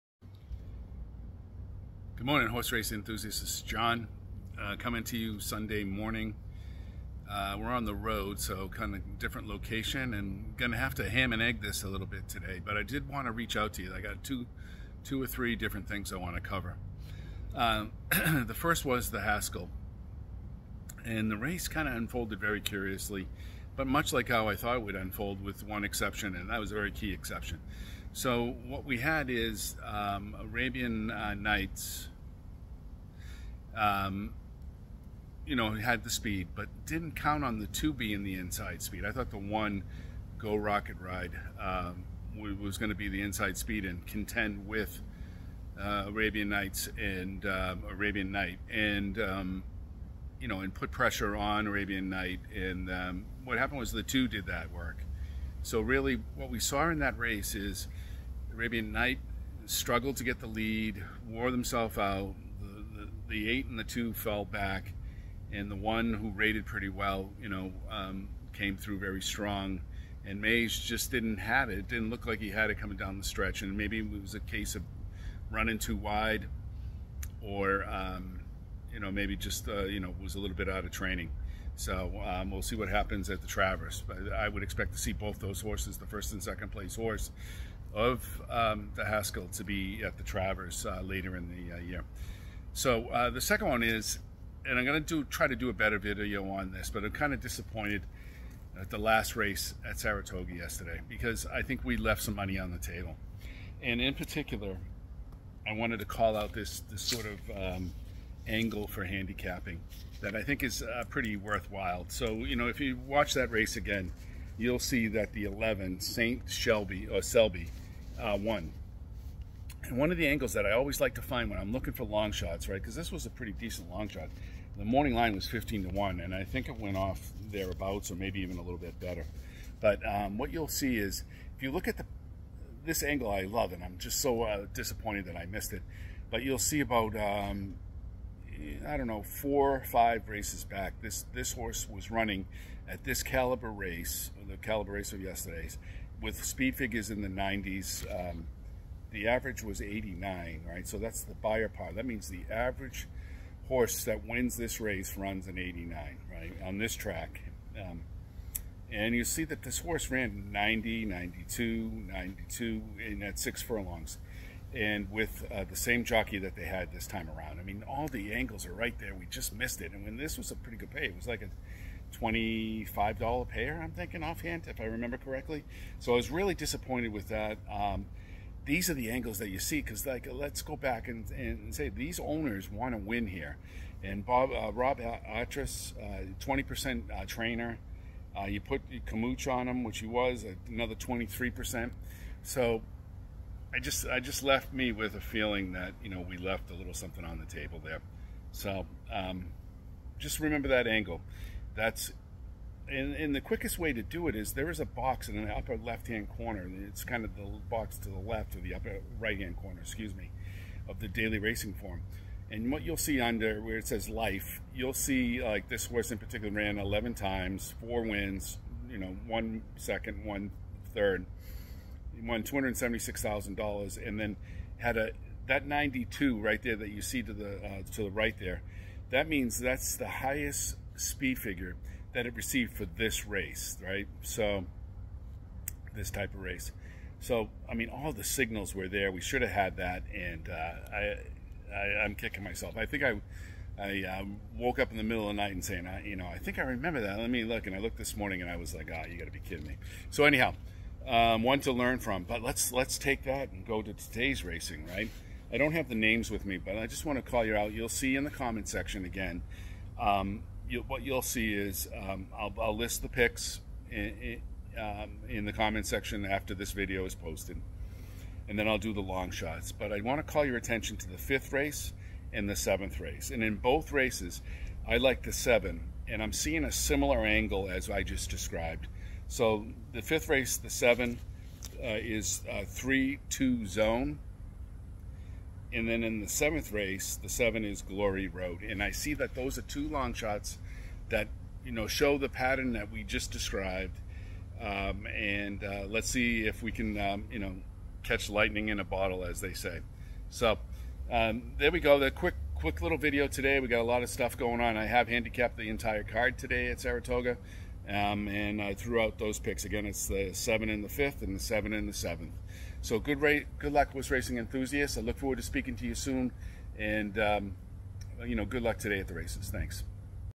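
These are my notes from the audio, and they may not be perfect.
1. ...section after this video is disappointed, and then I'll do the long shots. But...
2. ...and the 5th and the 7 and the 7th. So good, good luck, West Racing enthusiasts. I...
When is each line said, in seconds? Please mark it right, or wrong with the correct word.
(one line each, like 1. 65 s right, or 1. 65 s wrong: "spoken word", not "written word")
1. 265 s wrong: "posted", not "disappointed"
2. 310 s right.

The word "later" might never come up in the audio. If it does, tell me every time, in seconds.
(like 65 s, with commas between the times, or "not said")
91 s.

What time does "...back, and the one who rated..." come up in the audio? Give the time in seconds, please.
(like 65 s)
64 s.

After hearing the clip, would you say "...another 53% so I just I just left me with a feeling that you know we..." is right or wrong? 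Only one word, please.
wrong.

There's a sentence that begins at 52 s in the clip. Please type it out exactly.
And um, what happened was the two did that work.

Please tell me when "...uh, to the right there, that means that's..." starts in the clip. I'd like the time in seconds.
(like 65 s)
227 s.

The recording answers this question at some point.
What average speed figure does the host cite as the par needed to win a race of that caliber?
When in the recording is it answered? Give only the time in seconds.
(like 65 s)
149 s.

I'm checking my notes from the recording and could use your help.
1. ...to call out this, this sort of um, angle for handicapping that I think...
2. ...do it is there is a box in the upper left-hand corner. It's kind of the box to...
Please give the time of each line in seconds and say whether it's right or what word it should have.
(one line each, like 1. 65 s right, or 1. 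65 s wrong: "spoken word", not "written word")
1. 105 s right
2. 204 s right.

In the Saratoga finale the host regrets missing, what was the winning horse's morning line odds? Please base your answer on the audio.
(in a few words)
15 to 1.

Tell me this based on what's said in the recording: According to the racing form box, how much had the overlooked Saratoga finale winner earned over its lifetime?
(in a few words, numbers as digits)
$276,000.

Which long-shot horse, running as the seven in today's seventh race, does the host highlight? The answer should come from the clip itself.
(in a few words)
Glory Road.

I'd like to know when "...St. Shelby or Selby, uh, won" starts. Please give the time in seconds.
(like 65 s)
115 s.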